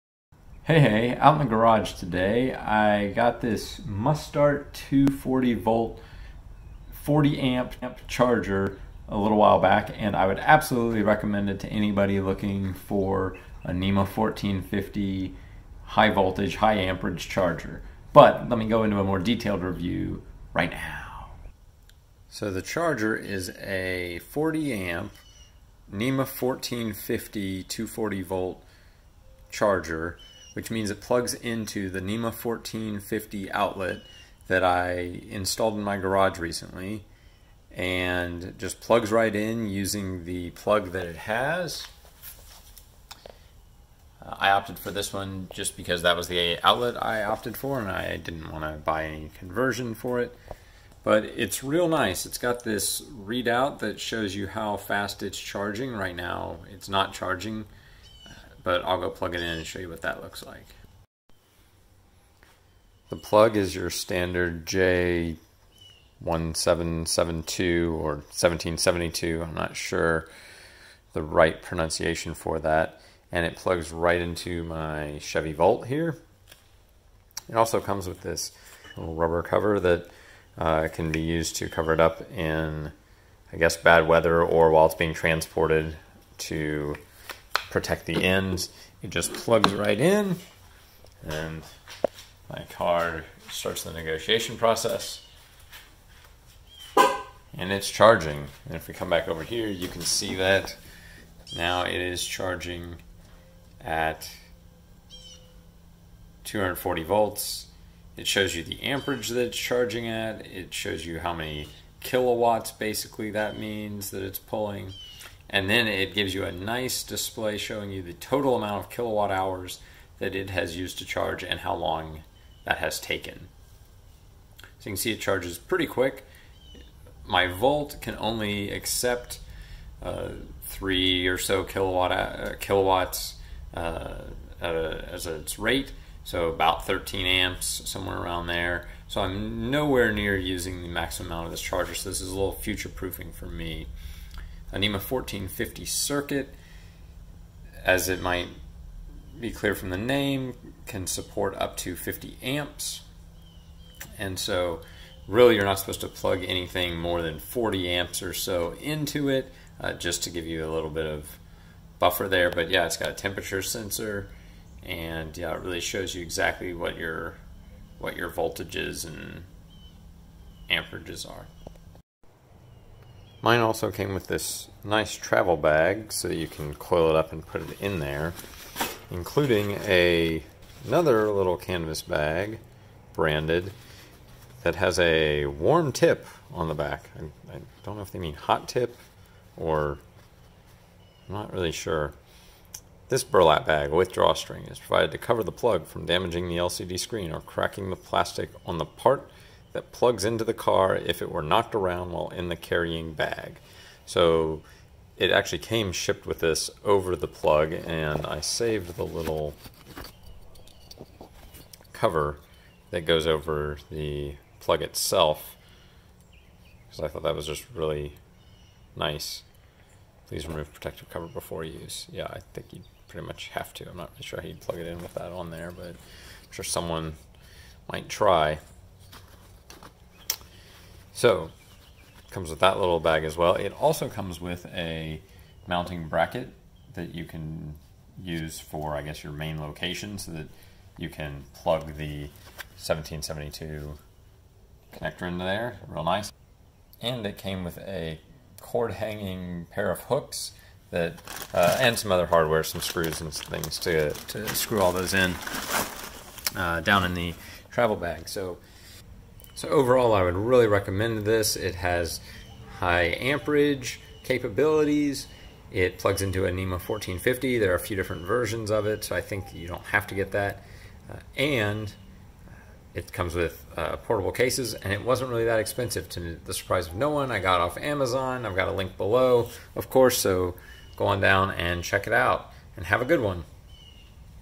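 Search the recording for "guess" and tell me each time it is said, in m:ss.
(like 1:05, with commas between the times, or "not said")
1:23, 3:59.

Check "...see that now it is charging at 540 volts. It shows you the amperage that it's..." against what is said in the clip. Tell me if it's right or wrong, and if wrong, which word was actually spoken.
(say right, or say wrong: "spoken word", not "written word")
wrong: "240", not "540".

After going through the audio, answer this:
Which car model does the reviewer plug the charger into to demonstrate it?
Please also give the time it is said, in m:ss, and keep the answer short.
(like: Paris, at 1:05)
Chevy Volt, at 1:15.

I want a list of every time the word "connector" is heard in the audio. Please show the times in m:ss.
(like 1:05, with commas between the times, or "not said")
4:04.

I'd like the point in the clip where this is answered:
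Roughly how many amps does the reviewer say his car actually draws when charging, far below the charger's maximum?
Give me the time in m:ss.
2:16.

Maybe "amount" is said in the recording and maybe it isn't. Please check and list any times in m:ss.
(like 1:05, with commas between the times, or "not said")
1:58, 2:21.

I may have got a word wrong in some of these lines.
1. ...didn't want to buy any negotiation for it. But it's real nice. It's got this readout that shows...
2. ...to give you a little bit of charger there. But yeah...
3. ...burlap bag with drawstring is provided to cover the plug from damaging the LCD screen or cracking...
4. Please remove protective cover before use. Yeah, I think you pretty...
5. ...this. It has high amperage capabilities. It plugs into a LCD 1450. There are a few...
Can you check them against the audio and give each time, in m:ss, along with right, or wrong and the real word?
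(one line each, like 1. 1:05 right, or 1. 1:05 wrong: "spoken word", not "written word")
1. 0:48 wrong: "conversion", not "negotiation"
2. 2:40 wrong: "buffer", not "charger"
3. 3:13 right
4. 3:40 right
5. 4:21 wrong: "NEMA", not "LCD".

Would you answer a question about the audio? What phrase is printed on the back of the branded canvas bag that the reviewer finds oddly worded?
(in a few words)
warm tip.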